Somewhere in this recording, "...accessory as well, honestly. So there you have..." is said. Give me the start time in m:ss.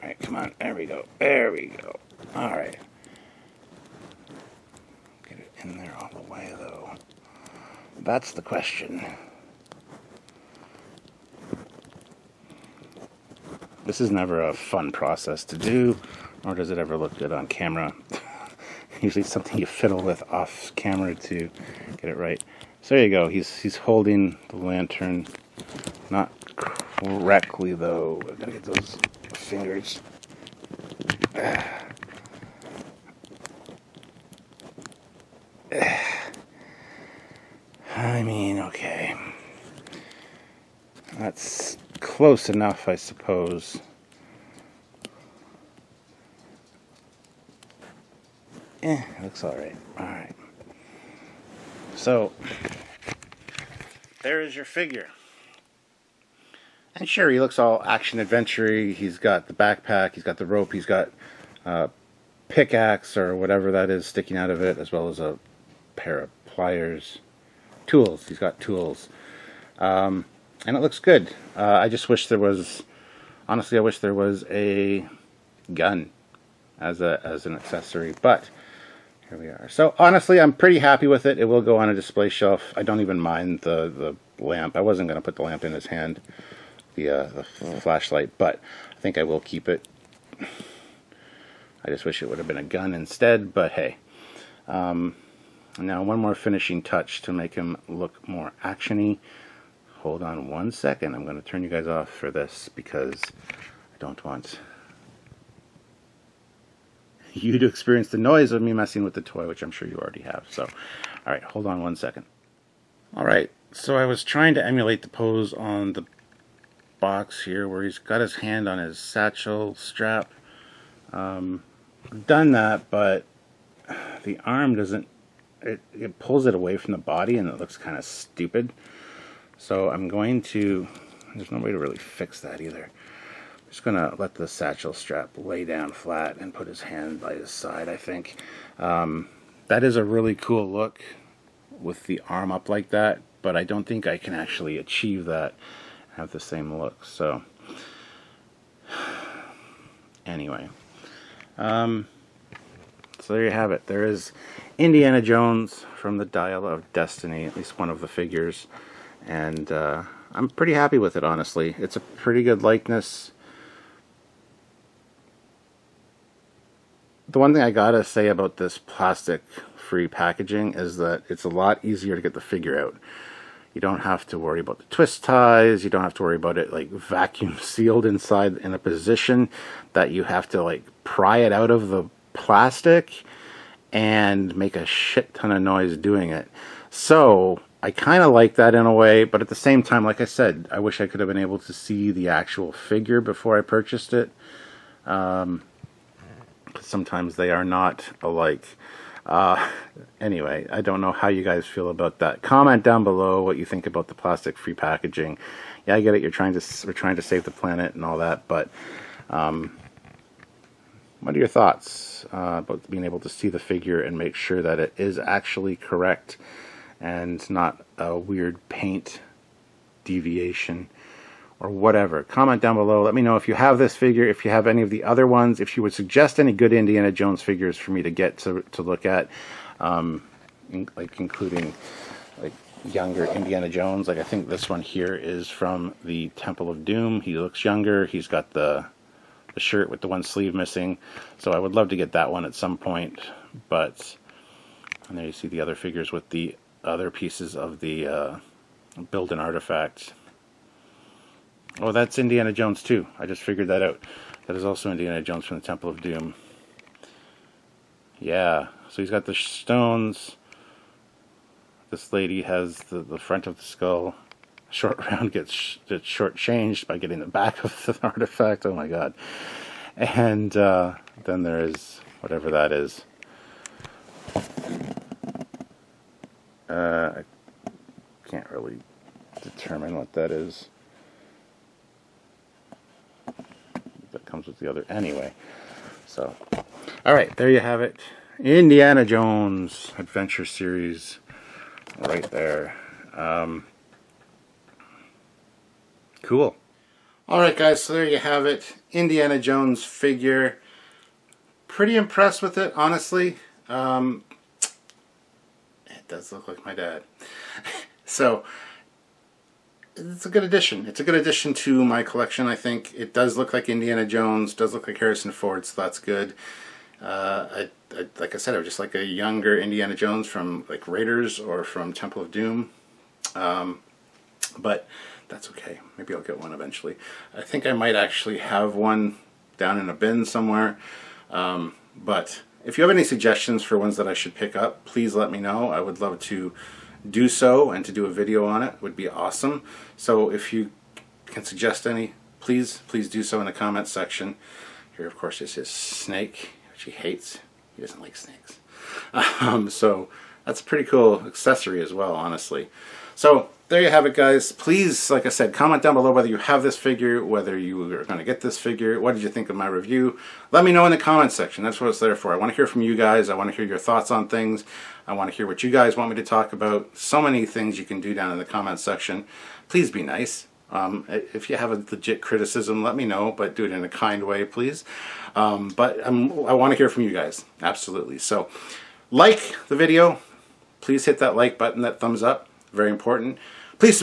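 5:51.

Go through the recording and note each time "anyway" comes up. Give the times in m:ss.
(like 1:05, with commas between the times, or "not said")
2:30, 3:20, 4:44.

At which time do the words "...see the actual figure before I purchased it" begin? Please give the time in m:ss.
3:11.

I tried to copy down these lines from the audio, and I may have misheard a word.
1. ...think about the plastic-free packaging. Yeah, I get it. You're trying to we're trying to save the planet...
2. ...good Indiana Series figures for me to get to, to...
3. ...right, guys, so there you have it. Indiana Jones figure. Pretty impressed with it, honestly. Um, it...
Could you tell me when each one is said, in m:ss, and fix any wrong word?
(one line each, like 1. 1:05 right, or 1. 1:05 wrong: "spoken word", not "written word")
1. 3:23 right
2. 3:46 wrong: "Jones", not "Series"
3. 4:57 right.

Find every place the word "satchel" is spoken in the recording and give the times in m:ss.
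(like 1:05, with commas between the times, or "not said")
1:58, 2:14.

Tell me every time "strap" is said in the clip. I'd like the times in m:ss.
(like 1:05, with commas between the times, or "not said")
1:59, 2:14.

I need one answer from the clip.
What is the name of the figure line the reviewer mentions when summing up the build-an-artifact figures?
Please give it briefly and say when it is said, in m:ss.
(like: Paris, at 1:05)
Indiana Jones Adventure Series, at 4:48.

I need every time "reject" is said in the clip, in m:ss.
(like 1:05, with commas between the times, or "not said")
not said.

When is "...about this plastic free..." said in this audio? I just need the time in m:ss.
2:48.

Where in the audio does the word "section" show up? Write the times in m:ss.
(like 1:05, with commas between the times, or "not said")
5:43, 6:01, 6:08.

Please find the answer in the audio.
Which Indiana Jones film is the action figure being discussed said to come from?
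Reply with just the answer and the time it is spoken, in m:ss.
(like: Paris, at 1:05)
Dial of Destiny, at 2:36.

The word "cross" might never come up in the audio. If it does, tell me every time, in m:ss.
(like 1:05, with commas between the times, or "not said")
not said.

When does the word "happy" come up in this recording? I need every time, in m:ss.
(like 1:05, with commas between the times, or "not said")
1:20, 2:40.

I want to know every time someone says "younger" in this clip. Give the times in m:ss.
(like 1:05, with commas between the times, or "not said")
3:52, 3:57, 5:19.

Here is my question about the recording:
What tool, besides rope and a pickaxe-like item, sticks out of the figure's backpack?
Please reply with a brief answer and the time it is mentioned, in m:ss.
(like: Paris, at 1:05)
pliers, at 1:05.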